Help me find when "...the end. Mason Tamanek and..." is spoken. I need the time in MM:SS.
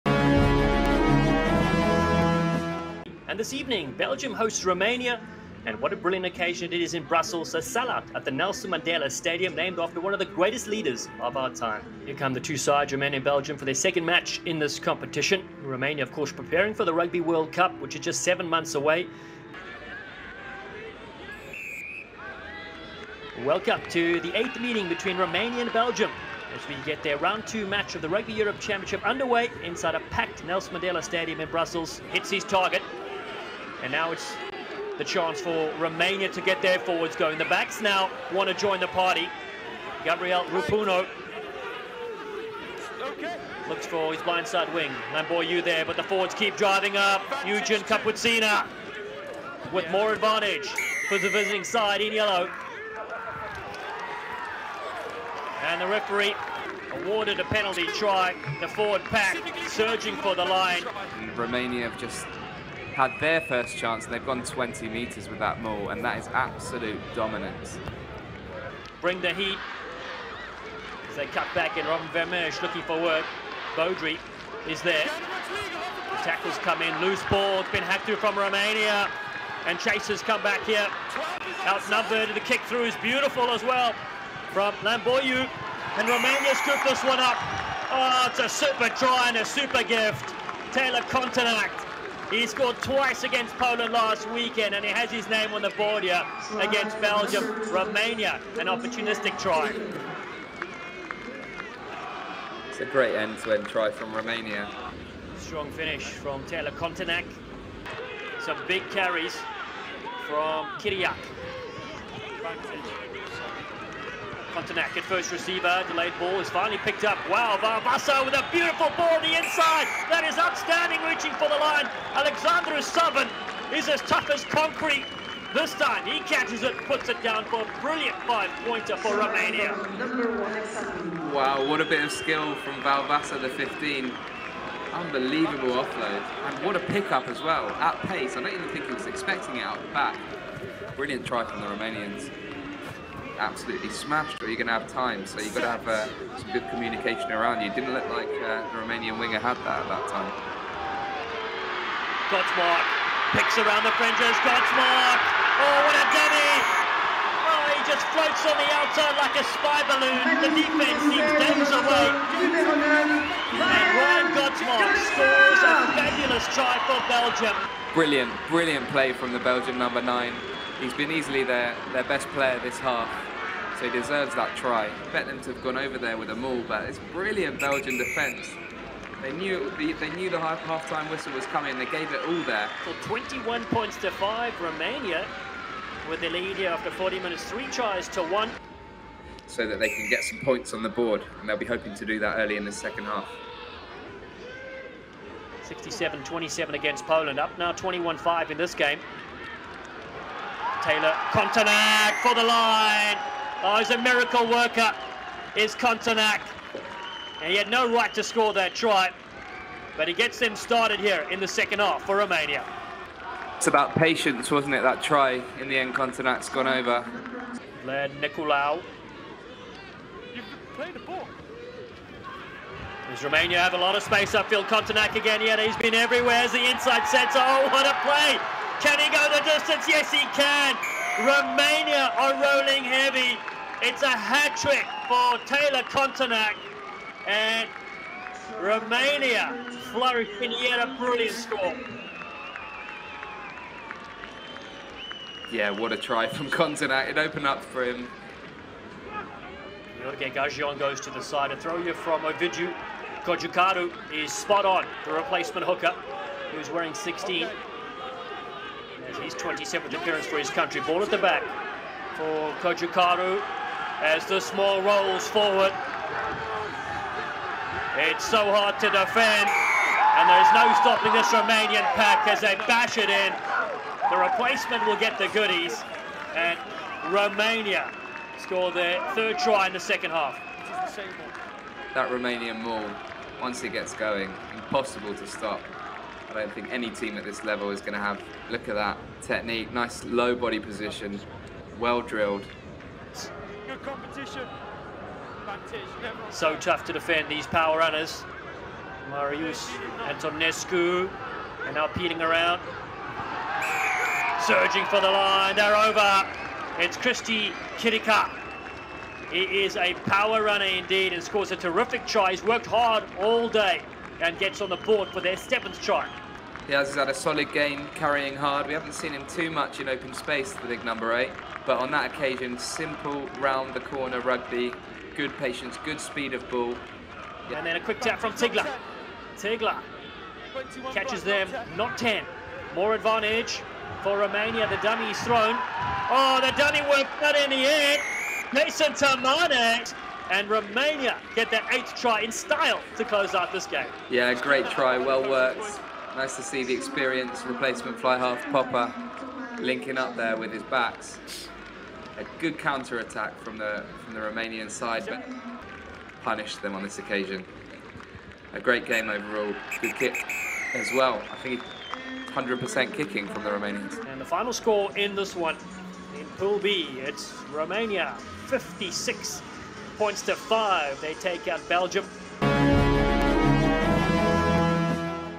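05:37.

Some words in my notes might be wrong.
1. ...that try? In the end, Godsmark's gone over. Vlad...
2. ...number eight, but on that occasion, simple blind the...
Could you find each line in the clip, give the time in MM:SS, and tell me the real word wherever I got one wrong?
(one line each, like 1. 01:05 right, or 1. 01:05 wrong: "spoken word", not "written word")
1. 03:34 wrong: "Gontineac", not "Godsmark"
2. 05:20 wrong: "round", not "blind".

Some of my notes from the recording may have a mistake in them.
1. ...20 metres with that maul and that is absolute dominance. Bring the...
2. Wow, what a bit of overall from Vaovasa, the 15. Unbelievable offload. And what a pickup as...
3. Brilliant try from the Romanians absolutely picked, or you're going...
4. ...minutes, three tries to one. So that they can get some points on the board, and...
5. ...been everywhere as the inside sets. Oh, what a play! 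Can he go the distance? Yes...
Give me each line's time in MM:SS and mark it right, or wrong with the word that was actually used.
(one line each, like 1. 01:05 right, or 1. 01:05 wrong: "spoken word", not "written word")
1. 01:04 right
2. 02:11 wrong: "skill", not "overall"
3. 02:20 wrong: "smashed", not "picked"
4. 03:07 right
5. 03:45 right.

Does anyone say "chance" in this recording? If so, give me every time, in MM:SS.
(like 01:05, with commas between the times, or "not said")
00:35, 01:03.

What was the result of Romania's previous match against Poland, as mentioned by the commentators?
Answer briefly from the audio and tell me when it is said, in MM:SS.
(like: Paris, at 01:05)
67-27, at 03:15.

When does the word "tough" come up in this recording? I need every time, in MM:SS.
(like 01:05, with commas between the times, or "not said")
02:04, 04:56.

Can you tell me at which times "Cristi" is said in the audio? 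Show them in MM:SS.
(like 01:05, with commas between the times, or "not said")
05:06.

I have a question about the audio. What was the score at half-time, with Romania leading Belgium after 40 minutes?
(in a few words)
21-5.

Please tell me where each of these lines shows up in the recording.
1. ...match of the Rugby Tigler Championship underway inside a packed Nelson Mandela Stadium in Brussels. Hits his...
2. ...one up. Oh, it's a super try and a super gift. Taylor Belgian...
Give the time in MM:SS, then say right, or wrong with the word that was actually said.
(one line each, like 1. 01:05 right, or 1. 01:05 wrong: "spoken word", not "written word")
1. 00:27 wrong: "Europe", not "Tigler"
2. 01:27 wrong: "Gontineac", not "Belgian".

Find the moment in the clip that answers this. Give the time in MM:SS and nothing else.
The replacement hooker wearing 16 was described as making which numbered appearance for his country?
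04:19.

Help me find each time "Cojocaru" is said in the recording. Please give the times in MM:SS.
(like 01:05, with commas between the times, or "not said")
04:13, 04:22.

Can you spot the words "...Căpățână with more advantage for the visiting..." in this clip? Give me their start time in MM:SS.
00:47.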